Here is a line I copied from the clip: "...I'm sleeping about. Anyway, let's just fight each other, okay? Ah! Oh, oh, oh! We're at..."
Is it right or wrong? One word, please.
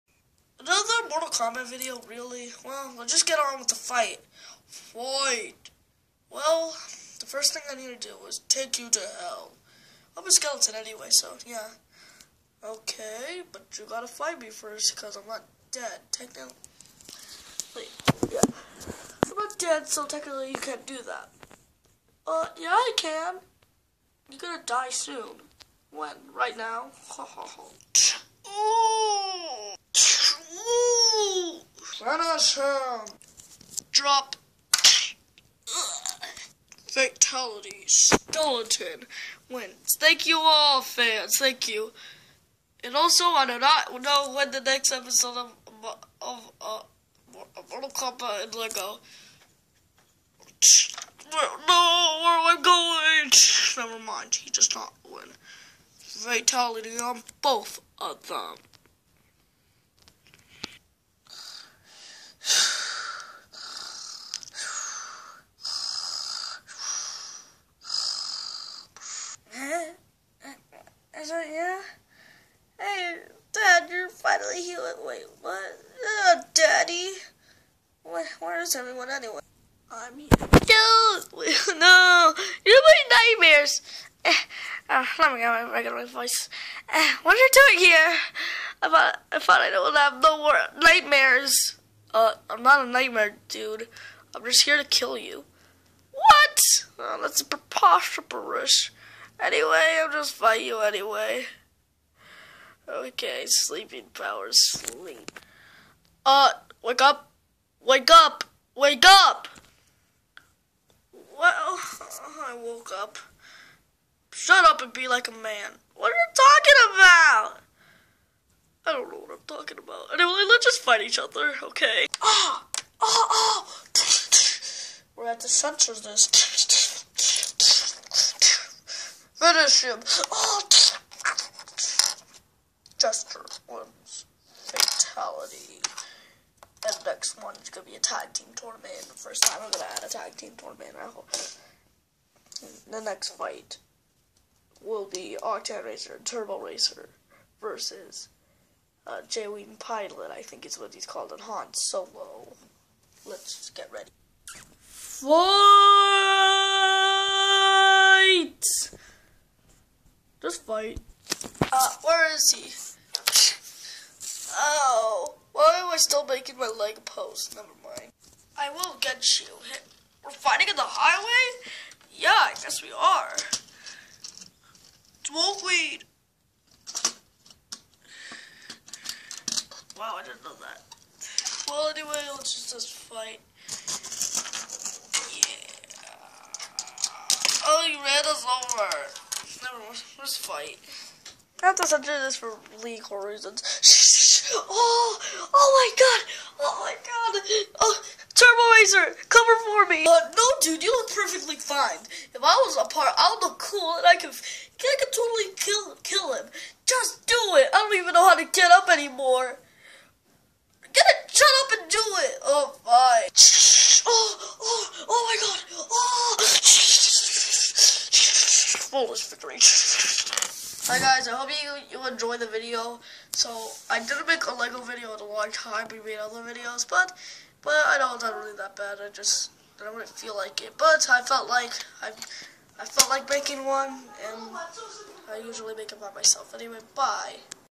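wrong.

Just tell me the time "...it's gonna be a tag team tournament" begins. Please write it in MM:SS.
02:17.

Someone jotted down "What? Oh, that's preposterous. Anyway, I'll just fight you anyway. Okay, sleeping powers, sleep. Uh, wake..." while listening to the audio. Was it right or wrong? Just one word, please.
right.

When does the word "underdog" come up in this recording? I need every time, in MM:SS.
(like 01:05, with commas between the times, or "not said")
not said.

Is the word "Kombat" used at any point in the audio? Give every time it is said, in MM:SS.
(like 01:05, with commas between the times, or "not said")
00:01, 00:47.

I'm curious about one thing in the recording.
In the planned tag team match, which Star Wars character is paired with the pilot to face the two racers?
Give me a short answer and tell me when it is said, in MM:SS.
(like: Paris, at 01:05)
Han Solo, at 02:31.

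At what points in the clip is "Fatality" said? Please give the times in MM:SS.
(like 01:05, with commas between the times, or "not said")
00:36, 00:55.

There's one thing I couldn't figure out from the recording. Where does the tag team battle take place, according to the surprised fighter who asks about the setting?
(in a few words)
the highway.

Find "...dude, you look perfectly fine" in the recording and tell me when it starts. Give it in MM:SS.
03:20.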